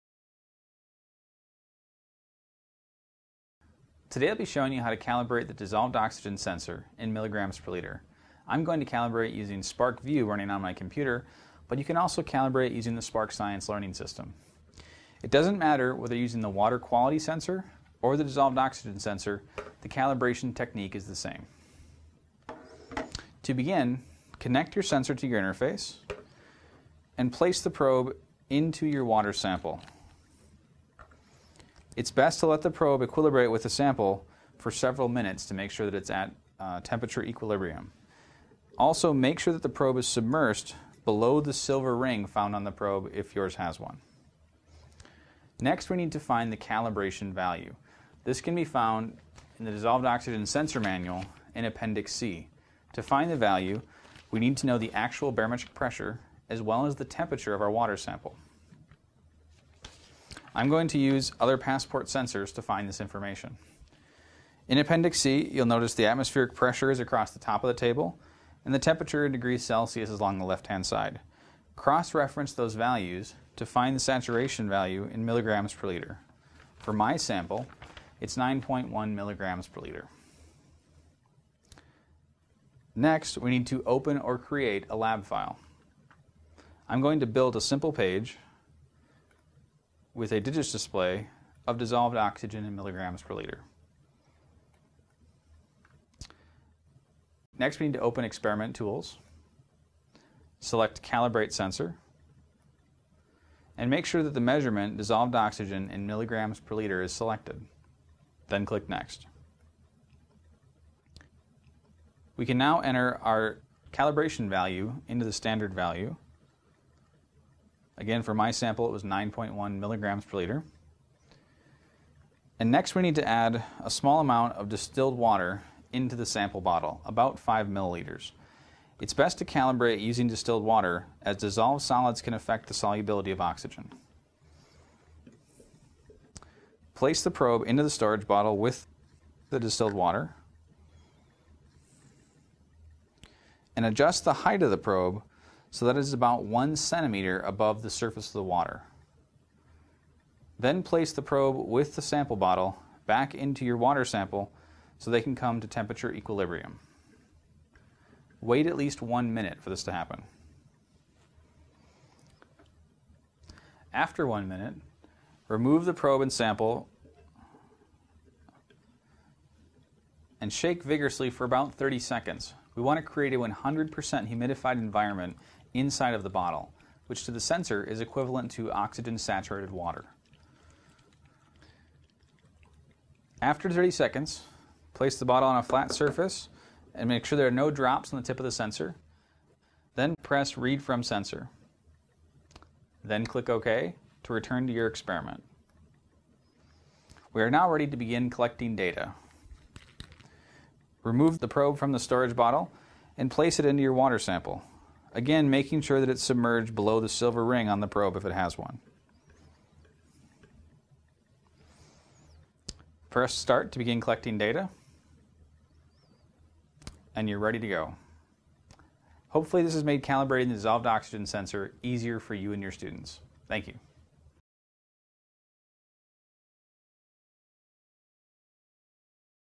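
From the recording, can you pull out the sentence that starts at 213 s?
Press start to begin collecting data.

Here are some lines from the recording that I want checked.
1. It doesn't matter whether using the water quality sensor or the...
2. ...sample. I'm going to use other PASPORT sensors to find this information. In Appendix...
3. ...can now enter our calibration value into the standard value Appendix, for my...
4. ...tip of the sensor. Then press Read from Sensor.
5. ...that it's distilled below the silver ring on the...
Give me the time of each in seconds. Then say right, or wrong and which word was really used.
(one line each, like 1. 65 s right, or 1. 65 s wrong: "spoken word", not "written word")
1. 15 s right
2. 57 s right
3. 112 s wrong: "Again", not "Appendix"
4. 188 s right
5. 205 s wrong: "submerged", not "distilled".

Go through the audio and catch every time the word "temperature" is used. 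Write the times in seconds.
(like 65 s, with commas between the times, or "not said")
36 s, 57 s, 68 s, 155 s.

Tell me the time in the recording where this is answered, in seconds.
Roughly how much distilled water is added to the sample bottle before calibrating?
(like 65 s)
127 s.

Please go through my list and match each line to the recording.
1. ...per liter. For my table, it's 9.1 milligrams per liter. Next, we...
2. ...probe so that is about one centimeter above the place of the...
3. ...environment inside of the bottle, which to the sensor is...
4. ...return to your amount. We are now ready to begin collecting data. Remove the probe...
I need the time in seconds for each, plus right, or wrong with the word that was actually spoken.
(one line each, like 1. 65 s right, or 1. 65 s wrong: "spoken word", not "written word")
1. 75 s wrong: "sample", not "table"
2. 144 s wrong: "surface", not "place"
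3. 174 s right
4. 194 s wrong: "experiment", not "amount".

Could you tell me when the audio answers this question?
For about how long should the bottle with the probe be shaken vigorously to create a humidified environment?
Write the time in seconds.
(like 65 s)
171 s.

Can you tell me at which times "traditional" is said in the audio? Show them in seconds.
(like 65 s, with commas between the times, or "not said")
not said.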